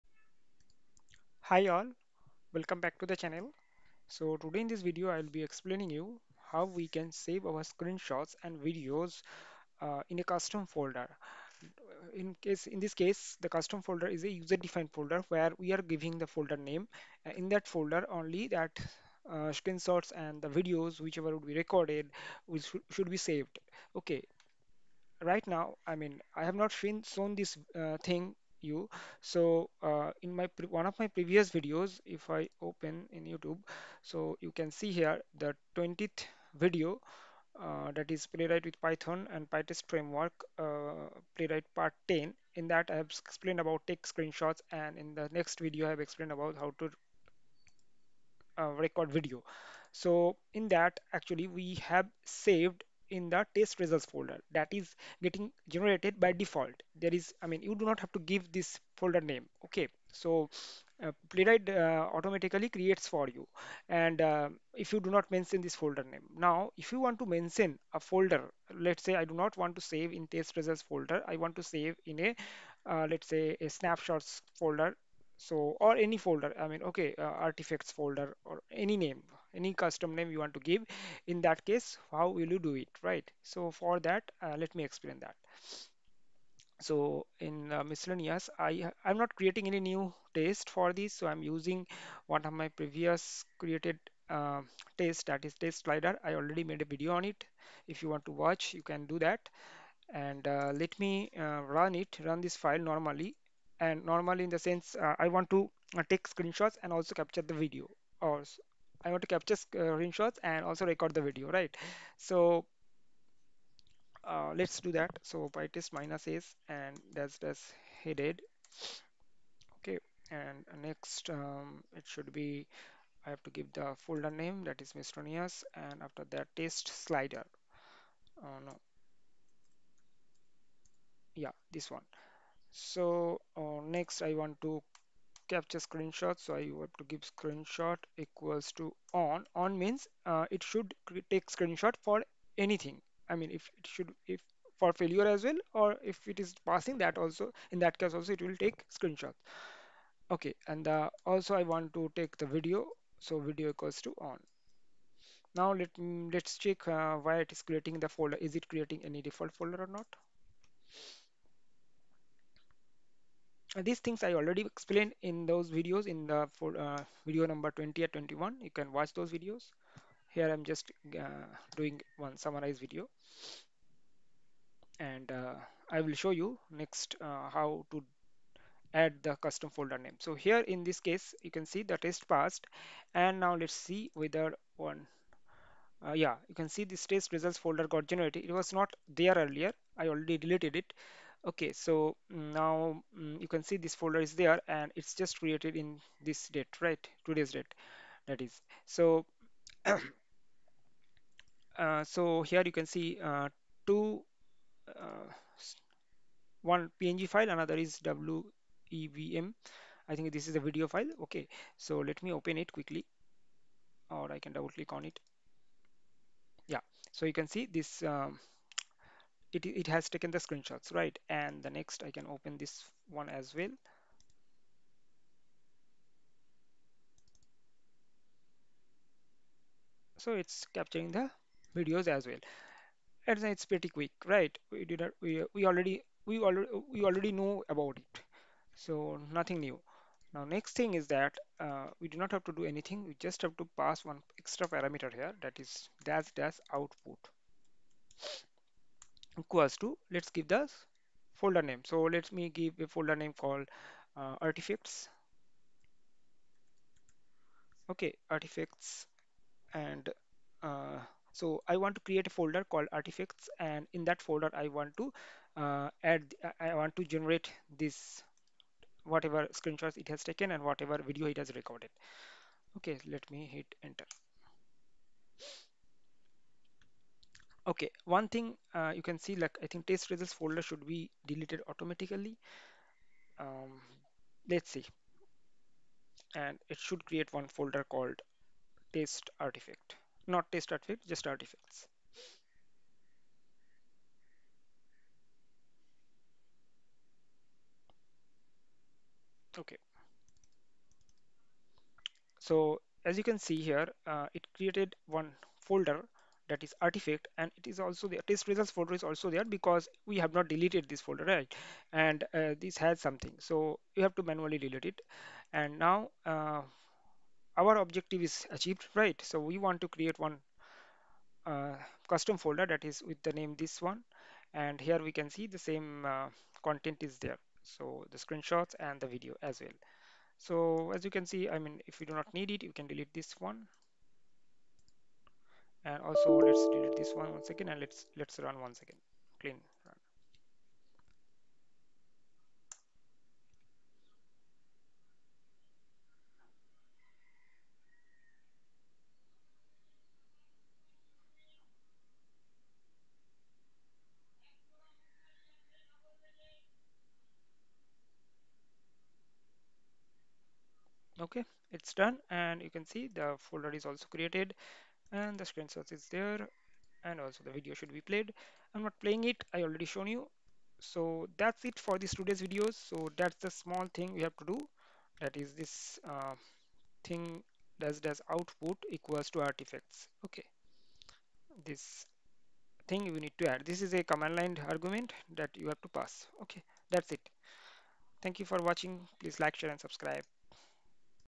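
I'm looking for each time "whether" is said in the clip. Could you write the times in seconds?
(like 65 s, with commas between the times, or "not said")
184 s.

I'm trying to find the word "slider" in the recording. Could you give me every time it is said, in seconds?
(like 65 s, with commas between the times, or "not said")
95 s, 126 s.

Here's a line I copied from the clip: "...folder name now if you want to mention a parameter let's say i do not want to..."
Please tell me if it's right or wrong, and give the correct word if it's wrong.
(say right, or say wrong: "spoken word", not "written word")
wrong: "folder", not "parameter".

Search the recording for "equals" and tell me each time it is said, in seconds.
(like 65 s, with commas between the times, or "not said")
138 s, 153 s, 249 s, 378 s.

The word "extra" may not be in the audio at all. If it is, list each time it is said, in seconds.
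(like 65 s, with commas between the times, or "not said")
244 s.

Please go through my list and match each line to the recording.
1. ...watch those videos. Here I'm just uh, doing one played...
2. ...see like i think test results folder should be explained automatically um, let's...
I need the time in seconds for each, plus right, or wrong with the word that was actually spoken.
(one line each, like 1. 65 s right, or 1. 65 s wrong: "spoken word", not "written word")
1. 168 s wrong: "summarized", not "played"
2. 279 s wrong: "deleted", not "explained".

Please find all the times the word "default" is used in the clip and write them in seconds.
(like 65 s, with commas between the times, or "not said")
56 s, 159 s.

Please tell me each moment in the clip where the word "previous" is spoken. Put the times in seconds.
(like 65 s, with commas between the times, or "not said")
31 s, 92 s.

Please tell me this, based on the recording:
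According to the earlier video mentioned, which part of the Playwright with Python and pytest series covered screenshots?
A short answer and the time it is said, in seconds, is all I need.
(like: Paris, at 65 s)
Part 10, at 41 s.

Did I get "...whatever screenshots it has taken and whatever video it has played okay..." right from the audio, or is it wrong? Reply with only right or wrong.
wrong.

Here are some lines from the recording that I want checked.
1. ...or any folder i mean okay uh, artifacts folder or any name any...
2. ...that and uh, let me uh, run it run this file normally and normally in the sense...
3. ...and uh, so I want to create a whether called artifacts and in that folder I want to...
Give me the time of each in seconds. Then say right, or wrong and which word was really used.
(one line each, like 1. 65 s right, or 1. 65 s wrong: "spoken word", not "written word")
1. 75 s right
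2. 99 s right
3. 259 s wrong: "folder", not "whether".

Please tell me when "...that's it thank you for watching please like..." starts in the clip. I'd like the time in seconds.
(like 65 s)
386 s.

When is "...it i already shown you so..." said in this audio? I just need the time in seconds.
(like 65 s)
369 s.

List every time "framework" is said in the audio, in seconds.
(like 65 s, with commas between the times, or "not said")
39 s.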